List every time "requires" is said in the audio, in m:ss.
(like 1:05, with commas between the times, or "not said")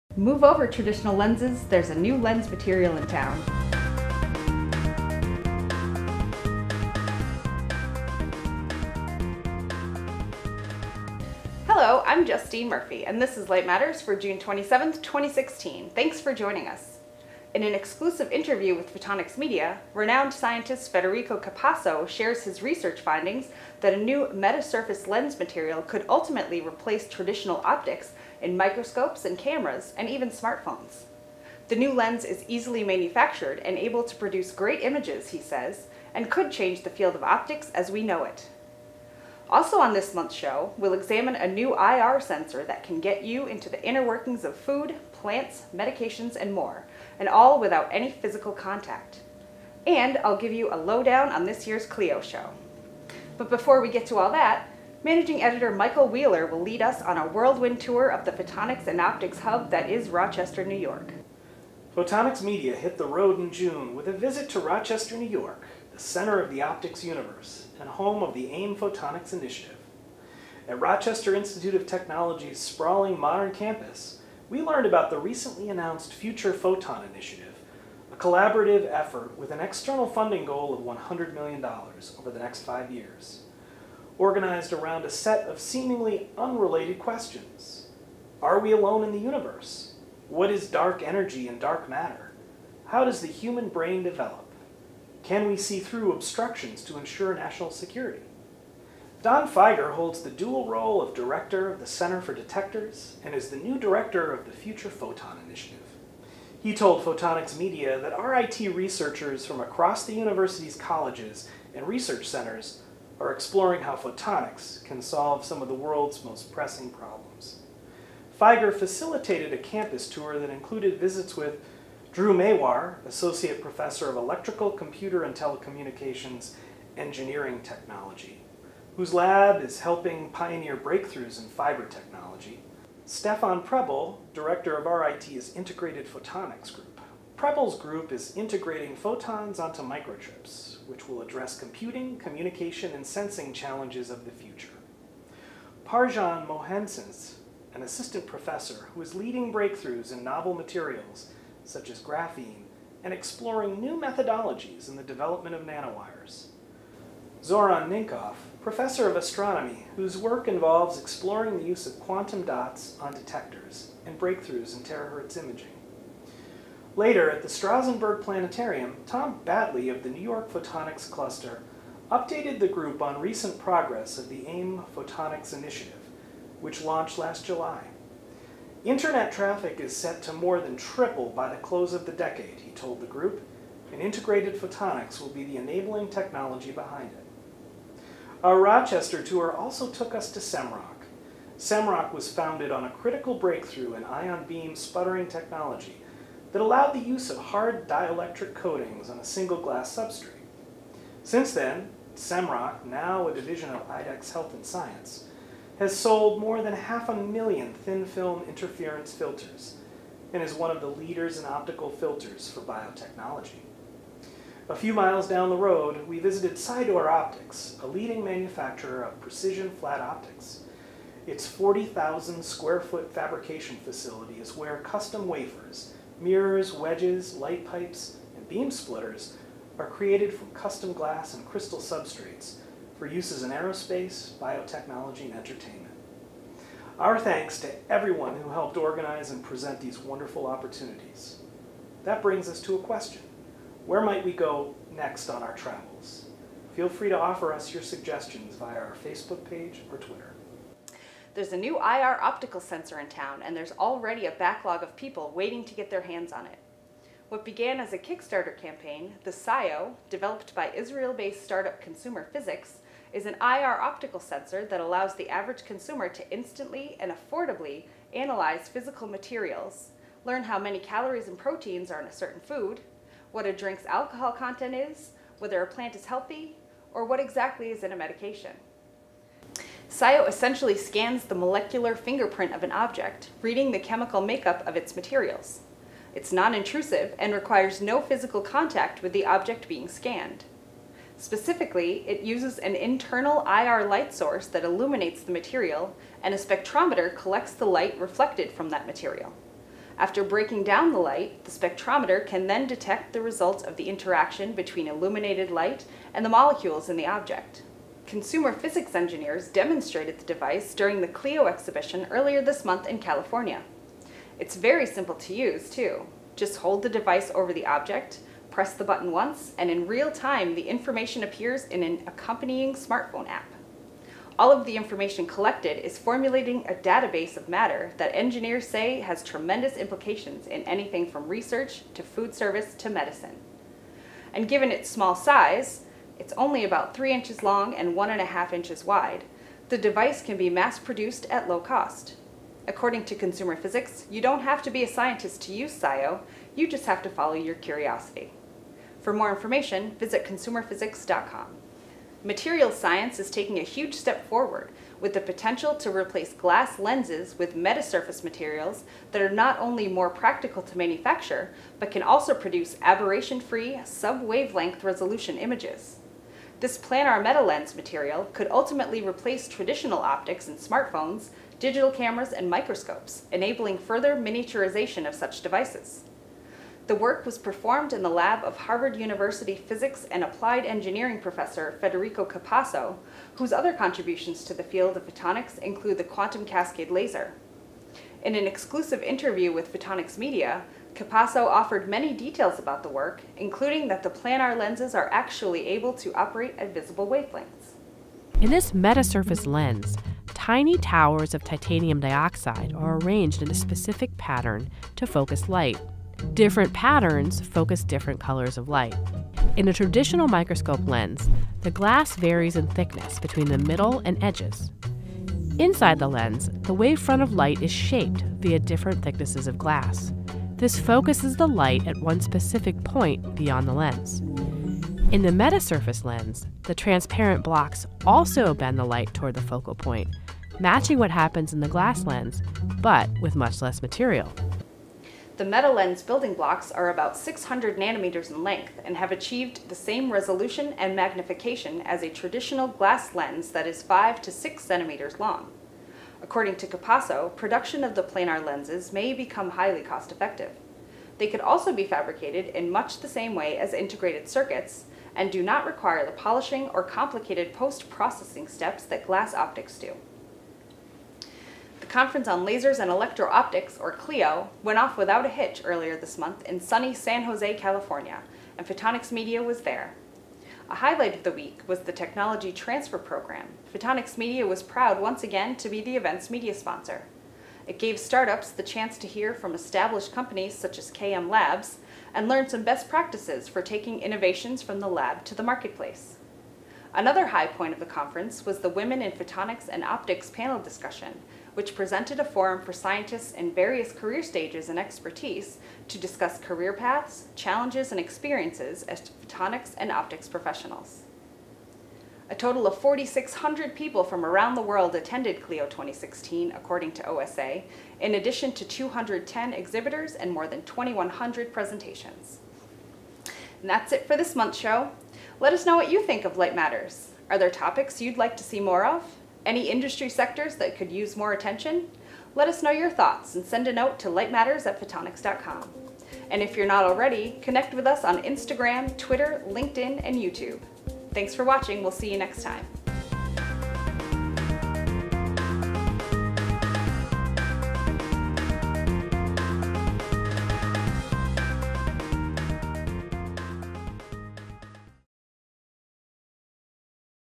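4:47, 7:35.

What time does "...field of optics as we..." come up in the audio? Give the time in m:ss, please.
0:36.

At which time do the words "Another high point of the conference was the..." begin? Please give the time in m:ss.
8:06.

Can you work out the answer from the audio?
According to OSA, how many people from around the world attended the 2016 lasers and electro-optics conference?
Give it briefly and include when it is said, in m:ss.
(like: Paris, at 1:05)
4,600, at 8:22.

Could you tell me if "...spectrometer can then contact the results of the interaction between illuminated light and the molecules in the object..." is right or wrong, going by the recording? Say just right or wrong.
wrong.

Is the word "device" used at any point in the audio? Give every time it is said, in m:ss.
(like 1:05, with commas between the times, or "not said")
5:10, 5:16, 5:39, 6:15.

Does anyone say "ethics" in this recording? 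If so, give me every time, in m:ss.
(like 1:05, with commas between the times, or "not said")
not said.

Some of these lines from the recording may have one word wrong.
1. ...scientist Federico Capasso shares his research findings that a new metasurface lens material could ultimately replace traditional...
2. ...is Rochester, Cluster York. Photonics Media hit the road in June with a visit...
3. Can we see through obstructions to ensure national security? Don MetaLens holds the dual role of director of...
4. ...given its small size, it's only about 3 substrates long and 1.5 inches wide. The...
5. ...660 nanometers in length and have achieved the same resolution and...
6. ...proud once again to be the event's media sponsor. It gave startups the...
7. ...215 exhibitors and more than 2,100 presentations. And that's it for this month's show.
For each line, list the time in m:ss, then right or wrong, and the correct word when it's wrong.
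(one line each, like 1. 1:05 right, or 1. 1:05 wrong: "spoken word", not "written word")
1. 0:20 right
2. 0:59 wrong: "New", not "Cluster"
3. 1:35 wrong: "Figer", not "MetaLens"
4. 5:34 wrong: "inches", not "substrates"
5. 7:17 wrong: "600", not "660"
6. 7:54 right
7. 8:28 wrong: "210", not "215".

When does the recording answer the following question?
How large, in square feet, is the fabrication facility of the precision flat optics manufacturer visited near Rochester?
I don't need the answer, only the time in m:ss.
3:41.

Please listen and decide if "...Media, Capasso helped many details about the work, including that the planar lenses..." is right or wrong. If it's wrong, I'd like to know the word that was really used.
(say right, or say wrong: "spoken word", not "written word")
wrong: "offered", not "helped".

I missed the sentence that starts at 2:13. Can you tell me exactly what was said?
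Stefan Preble, Director of RIT's Integrated Photonics Group.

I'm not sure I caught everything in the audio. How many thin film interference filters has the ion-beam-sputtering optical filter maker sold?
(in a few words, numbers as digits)
more than half a million.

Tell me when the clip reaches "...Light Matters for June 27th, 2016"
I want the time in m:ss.
0:13.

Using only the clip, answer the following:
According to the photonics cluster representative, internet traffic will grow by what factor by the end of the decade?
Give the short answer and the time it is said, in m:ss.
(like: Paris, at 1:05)
more than triple, at 3:00.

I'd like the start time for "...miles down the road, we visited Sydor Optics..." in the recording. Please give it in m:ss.
3:34.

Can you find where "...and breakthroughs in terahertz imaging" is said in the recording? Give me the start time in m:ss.
2:44.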